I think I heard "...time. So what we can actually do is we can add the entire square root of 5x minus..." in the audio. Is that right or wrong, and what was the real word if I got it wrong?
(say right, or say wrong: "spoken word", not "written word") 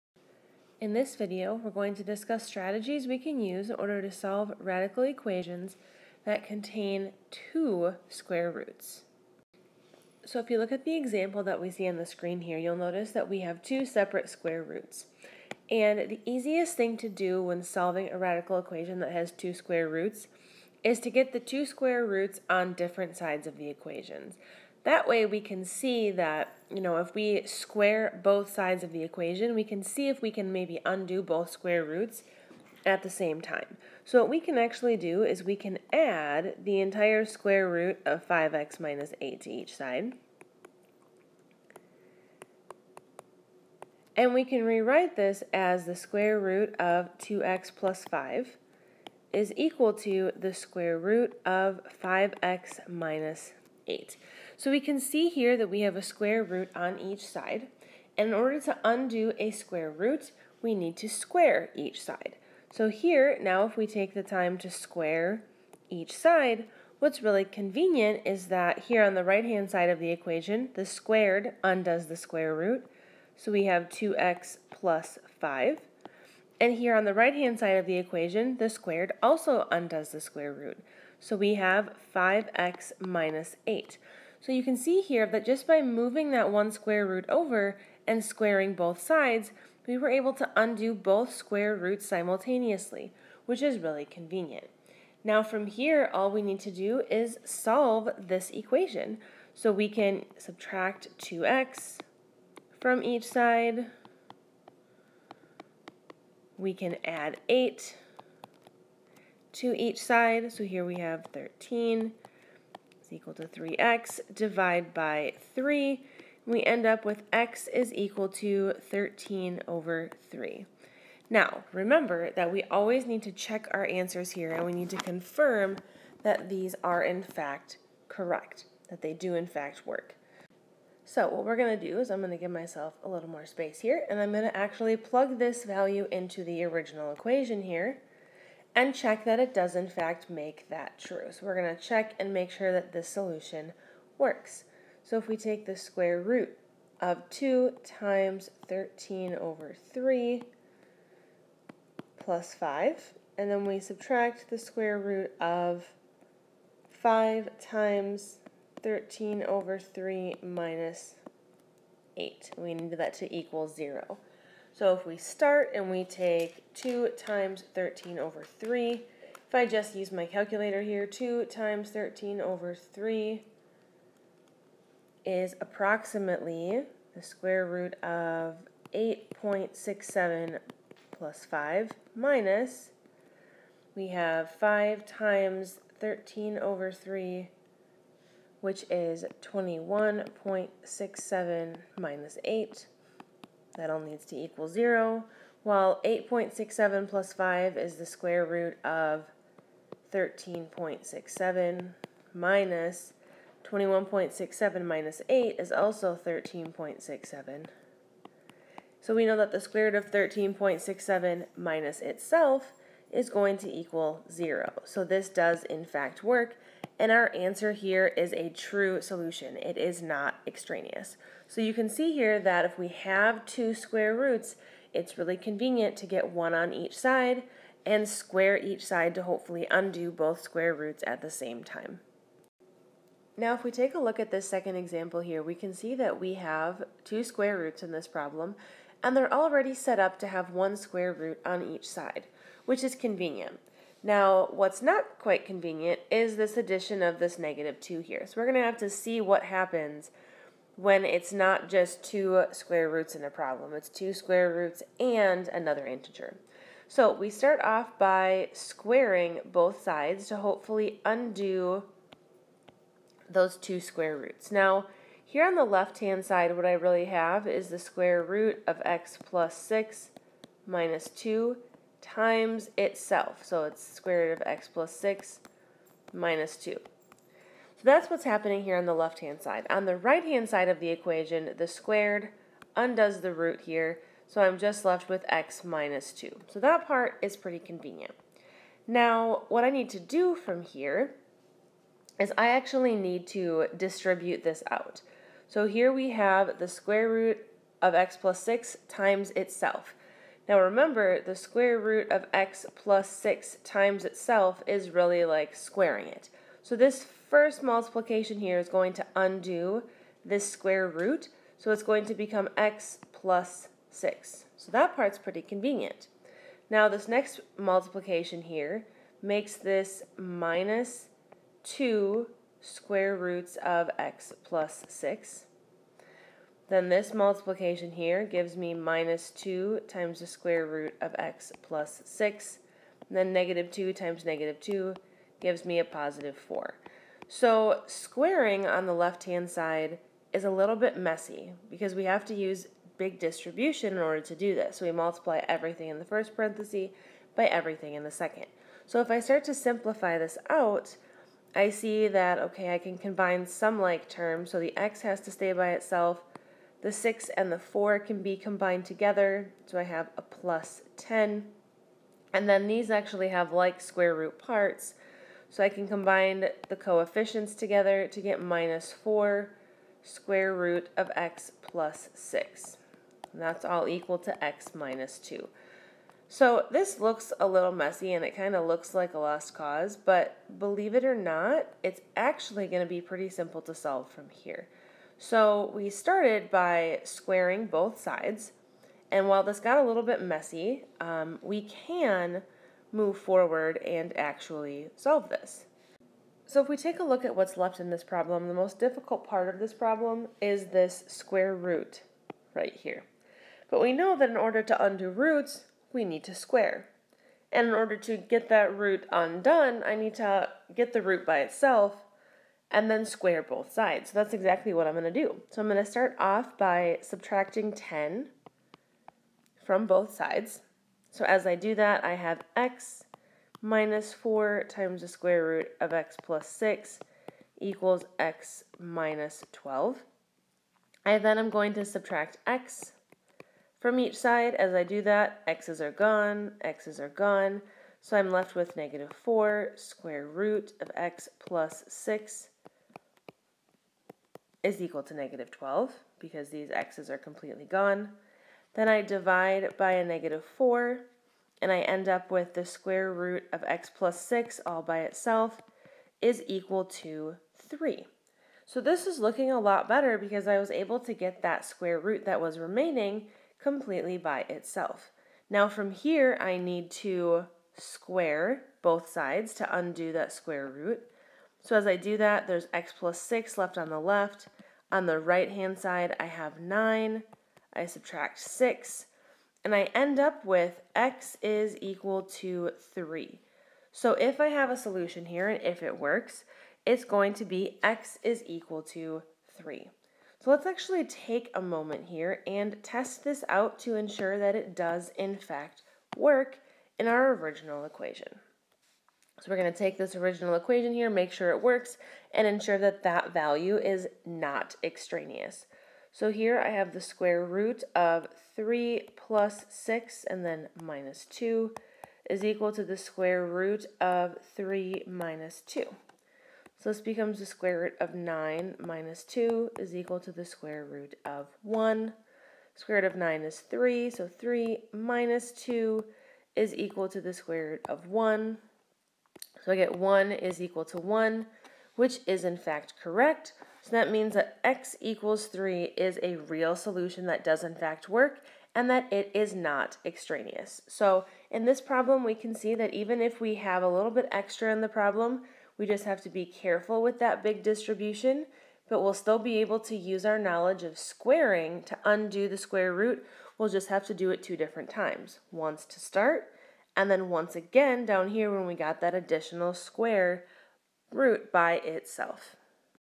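right.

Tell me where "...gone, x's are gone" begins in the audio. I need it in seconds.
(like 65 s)
435 s.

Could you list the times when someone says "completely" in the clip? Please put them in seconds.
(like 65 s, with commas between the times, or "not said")
447 s, 463 s.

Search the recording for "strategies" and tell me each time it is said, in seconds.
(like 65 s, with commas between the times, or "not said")
2 s.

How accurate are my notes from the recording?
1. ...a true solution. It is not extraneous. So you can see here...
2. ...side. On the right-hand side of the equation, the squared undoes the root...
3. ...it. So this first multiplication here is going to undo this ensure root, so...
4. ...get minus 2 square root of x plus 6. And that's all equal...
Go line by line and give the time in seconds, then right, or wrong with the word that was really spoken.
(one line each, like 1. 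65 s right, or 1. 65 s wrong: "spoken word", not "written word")
1. 218 s right
2. 279 s right
3. 306 s wrong: "square", not "ensure"
4. 368 s wrong: "4", not "2".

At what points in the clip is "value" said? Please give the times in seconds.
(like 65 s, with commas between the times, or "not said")
135 s, 503 s.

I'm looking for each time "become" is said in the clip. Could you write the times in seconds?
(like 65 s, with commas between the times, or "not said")
312 s, 517 s.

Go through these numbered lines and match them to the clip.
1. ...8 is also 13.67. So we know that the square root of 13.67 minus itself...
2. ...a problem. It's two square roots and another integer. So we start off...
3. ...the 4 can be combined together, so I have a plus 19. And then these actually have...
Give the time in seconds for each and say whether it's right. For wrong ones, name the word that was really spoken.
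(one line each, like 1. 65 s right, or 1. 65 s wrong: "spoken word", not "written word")
1. 205 s right
2. 253 s right
3. 357 s wrong: "10", not "19".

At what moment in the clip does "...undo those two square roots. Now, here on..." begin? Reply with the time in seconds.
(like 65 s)
261 s.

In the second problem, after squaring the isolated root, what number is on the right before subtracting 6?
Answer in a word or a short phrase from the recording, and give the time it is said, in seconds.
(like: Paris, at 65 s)
9, at 476 s.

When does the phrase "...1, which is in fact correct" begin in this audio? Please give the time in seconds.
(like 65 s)
530 s.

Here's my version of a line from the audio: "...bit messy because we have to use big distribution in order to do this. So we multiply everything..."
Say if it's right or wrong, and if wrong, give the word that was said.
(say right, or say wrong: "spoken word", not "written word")
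right.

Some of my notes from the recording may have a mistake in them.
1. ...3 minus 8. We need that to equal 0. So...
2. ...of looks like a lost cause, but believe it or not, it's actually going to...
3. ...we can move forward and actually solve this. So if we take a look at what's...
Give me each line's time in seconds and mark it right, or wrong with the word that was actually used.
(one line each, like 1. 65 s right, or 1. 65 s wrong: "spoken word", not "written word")
1. 159 s right
2. 378 s right
3. 391 s right.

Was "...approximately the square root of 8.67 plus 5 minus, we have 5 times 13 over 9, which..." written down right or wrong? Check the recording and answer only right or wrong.
wrong.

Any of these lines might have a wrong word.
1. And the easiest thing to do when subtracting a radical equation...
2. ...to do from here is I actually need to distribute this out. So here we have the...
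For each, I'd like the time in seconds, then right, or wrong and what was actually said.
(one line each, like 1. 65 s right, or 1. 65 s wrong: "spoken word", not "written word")
1. 15 s wrong: "solving", not "subtracting"
2. 289 s right.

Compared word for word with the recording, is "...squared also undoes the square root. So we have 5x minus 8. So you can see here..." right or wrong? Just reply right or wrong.
right.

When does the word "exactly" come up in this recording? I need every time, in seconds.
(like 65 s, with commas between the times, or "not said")
414 s.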